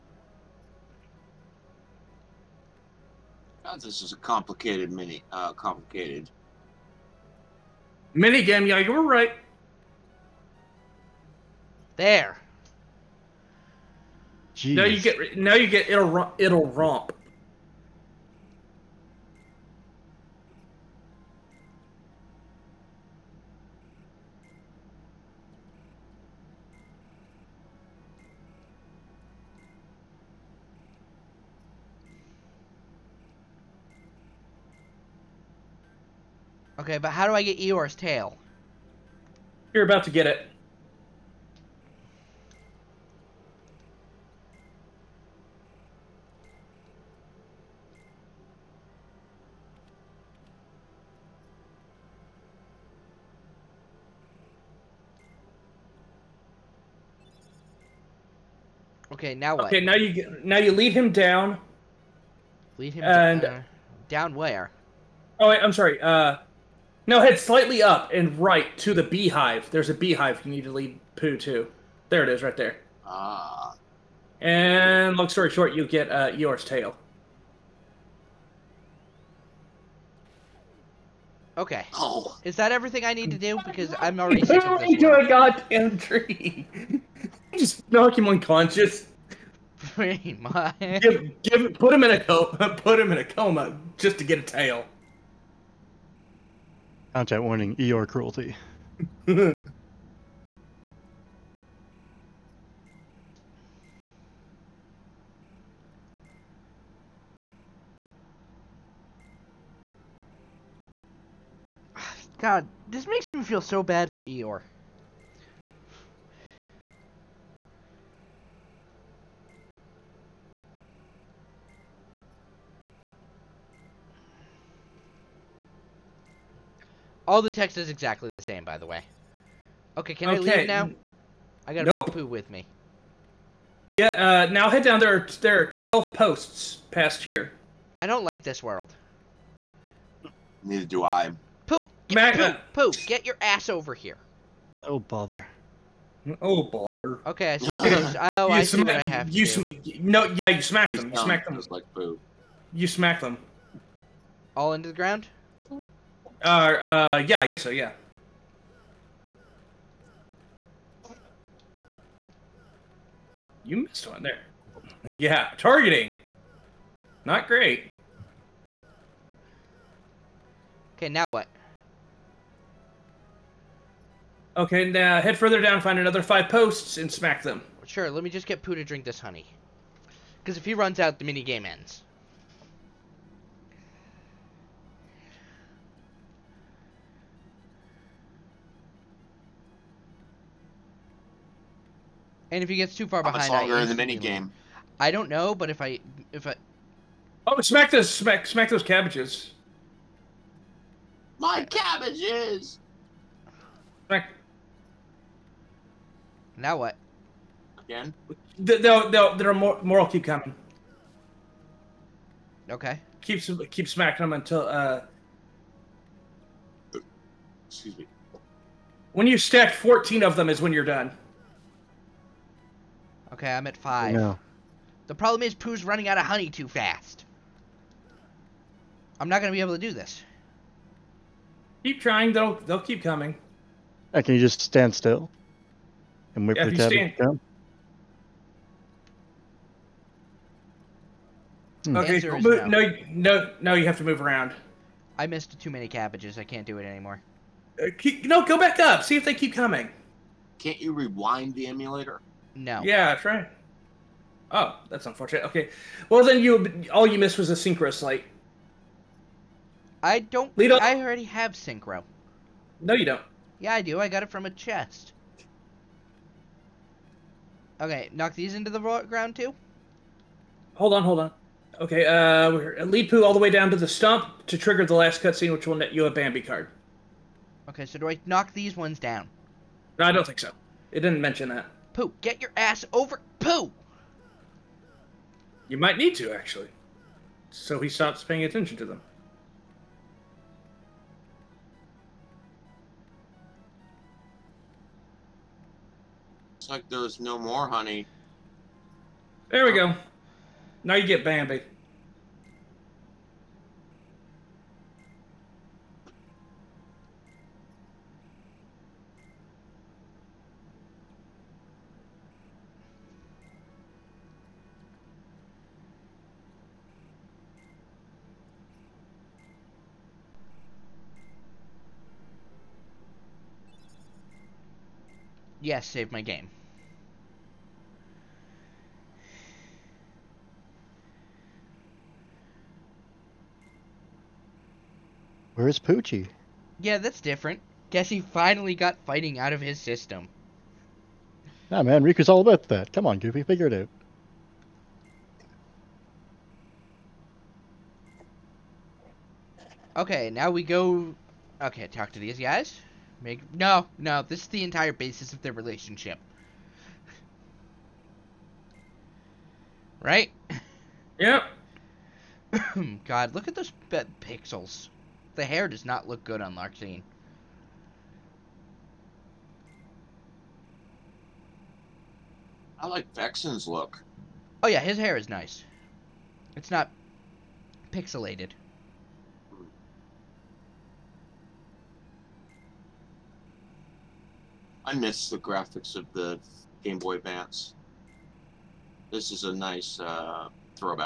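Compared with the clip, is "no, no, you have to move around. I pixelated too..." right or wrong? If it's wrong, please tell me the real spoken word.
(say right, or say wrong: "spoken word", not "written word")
wrong: "missed", not "pixelated".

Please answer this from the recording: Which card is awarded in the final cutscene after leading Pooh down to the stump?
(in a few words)
Bambi card.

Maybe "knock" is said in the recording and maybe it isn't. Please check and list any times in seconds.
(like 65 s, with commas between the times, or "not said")
87 s, 268 s, 278 s.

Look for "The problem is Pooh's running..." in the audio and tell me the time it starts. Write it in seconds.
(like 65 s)
225 s.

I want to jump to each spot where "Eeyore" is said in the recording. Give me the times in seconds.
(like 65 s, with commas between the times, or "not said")
37 s, 76 s, 114 s.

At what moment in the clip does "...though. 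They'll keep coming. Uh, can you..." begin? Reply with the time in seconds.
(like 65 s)
232 s.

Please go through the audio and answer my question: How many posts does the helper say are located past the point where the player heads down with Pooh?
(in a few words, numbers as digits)
12.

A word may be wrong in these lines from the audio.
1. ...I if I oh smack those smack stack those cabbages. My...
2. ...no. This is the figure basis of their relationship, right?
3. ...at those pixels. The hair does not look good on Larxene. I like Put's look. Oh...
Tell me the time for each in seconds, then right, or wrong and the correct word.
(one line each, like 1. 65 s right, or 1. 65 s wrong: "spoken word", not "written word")
1. 195 s wrong: "smack", not "stack"
2. 353 s wrong: "entire", not "figure"
3. 363 s wrong: "Vexen", not "Put".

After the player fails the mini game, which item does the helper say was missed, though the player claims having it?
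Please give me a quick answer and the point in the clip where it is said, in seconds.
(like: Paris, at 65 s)
Synchro slate, at 257 s.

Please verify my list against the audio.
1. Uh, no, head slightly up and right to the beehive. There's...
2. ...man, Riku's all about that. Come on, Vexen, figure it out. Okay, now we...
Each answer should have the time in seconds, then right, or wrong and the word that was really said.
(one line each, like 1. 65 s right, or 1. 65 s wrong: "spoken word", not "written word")
1. 65 s right
2. 341 s wrong: "Goofy", not "Vexen".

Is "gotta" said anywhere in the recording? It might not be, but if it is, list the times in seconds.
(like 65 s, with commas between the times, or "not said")
131 s.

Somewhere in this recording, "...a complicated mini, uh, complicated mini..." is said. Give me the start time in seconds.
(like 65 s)
4 s.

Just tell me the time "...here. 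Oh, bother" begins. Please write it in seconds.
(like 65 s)
143 s.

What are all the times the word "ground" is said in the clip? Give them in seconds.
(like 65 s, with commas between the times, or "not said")
154 s, 268 s.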